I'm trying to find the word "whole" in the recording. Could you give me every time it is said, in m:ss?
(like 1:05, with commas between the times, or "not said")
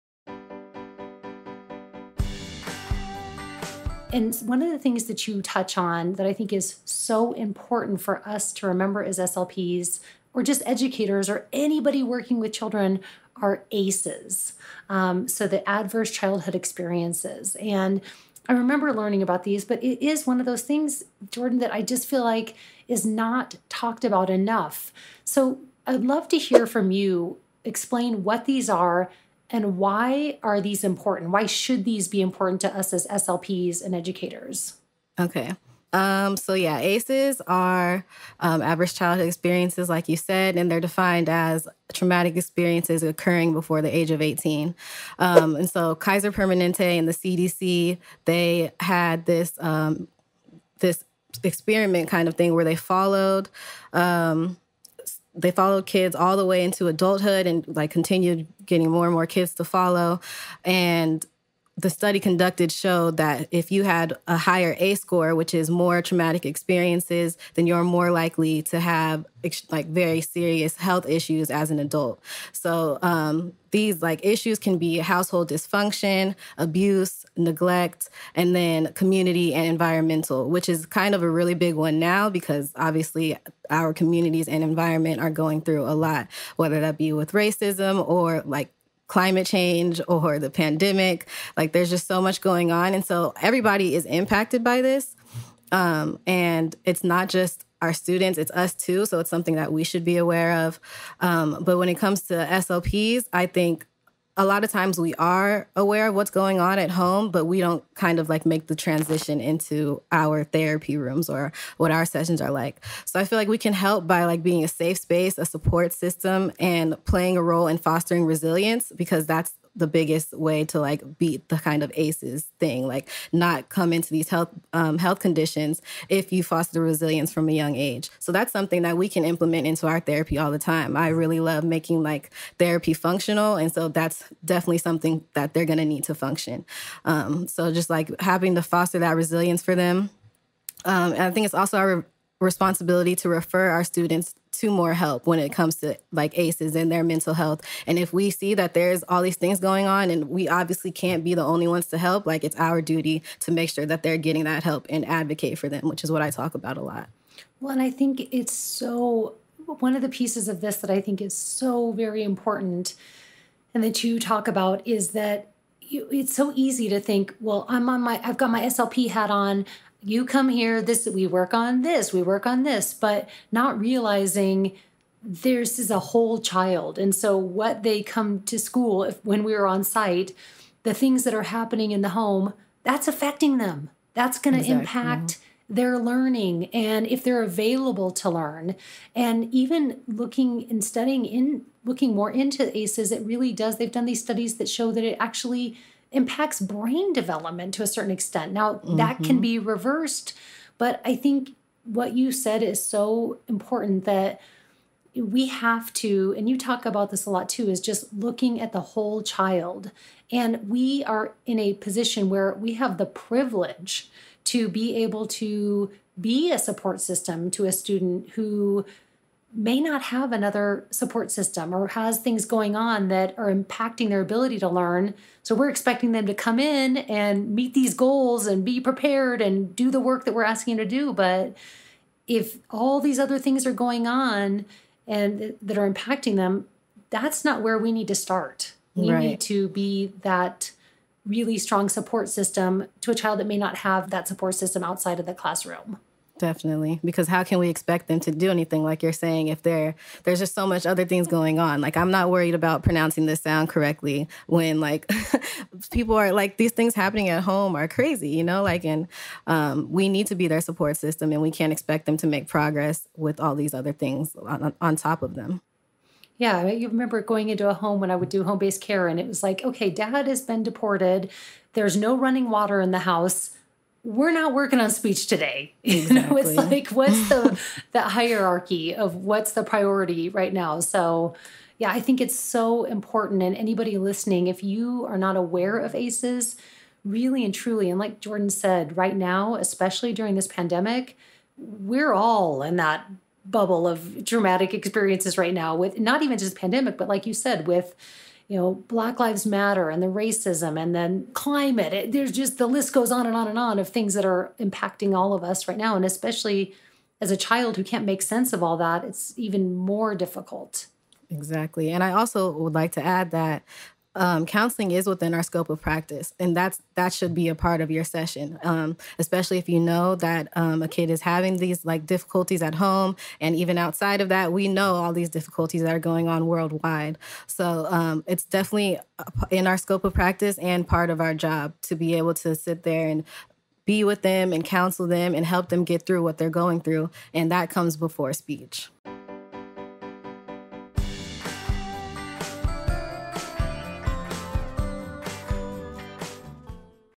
2:55, 3:28.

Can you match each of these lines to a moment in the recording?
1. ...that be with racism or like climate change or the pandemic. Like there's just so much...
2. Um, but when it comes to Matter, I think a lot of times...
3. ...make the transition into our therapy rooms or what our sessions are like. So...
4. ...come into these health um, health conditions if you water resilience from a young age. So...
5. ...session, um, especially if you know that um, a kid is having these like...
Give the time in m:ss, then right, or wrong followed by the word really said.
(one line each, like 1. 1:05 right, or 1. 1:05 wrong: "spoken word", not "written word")
1. 1:26 right
2. 1:41 wrong: "SLPs", not "Matter"
3. 1:48 right
4. 2:03 wrong: "foster", not "water"
5. 5:18 right.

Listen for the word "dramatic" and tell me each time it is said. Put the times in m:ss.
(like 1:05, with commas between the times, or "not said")
4:54.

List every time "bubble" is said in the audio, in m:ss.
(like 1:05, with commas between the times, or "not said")
4:53.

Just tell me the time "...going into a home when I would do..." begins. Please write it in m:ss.
4:27.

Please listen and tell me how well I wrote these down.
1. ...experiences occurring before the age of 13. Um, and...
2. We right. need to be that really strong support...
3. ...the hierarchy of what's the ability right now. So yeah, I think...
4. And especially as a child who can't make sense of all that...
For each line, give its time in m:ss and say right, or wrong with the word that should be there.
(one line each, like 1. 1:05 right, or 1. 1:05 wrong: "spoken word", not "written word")
1. 0:42 wrong: "18", not "13"
2. 3:58 right
3. 4:37 wrong: "priority", not "ability"
4. 5:05 right.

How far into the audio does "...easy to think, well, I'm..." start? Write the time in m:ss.
2:46.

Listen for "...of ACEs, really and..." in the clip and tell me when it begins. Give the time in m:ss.
4:45.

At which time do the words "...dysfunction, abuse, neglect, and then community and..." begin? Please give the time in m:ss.
1:15.